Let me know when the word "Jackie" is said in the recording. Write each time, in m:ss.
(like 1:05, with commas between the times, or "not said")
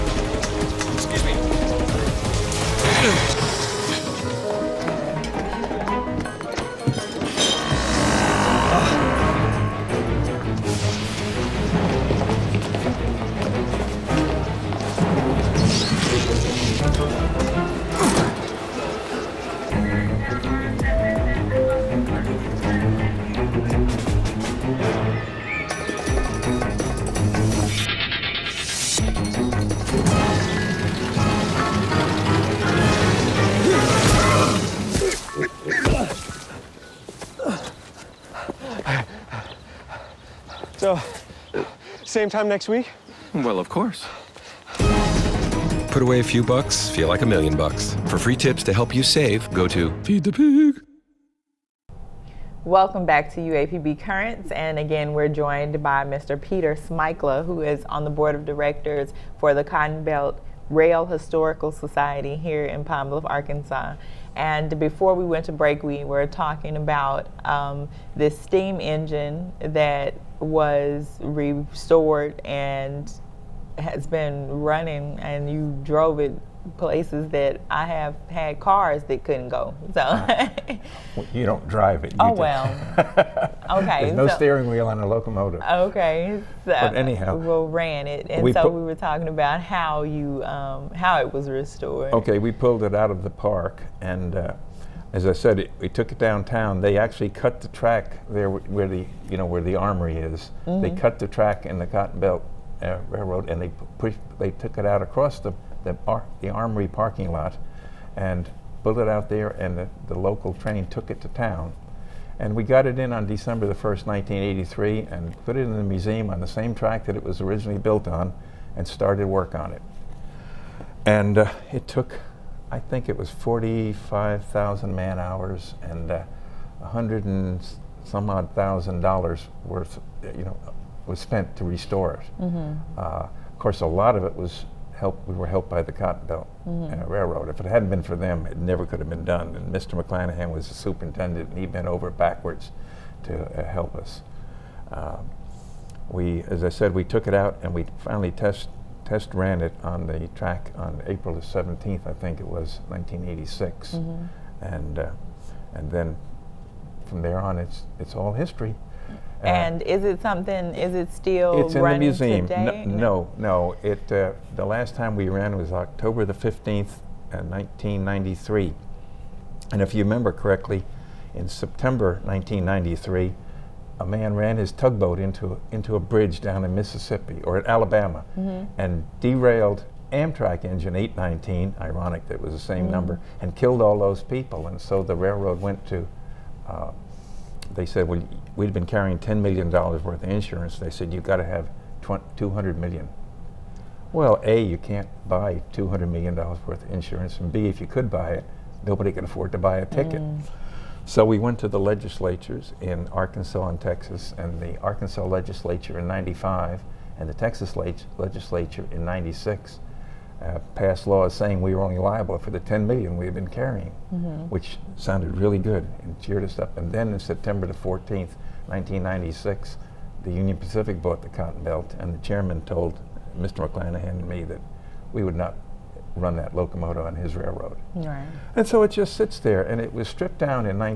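not said.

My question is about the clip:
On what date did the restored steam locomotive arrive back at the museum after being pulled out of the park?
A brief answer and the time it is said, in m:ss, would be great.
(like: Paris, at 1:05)
December 1, 1983, at 1:53.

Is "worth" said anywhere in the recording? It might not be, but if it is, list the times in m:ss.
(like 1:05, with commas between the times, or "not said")
2:09, 3:09, 3:16.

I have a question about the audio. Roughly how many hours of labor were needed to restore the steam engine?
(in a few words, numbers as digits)
45,000.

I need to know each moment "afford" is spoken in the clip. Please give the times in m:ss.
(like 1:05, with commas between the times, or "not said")
3:19.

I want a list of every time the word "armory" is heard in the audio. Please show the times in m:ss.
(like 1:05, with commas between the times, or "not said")
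1:39, 1:46.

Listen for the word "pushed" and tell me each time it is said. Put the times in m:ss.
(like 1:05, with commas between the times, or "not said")
1:43.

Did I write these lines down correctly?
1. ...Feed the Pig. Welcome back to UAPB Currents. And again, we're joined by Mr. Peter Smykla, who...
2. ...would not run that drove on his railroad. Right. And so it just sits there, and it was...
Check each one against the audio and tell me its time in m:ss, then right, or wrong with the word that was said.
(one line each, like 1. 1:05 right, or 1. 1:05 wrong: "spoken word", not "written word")
1. 0:50 right
2. 3:45 wrong: "locomotive", not "drove".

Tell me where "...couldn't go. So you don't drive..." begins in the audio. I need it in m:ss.
1:19.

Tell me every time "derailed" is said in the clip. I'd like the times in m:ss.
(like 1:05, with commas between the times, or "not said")
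2:59.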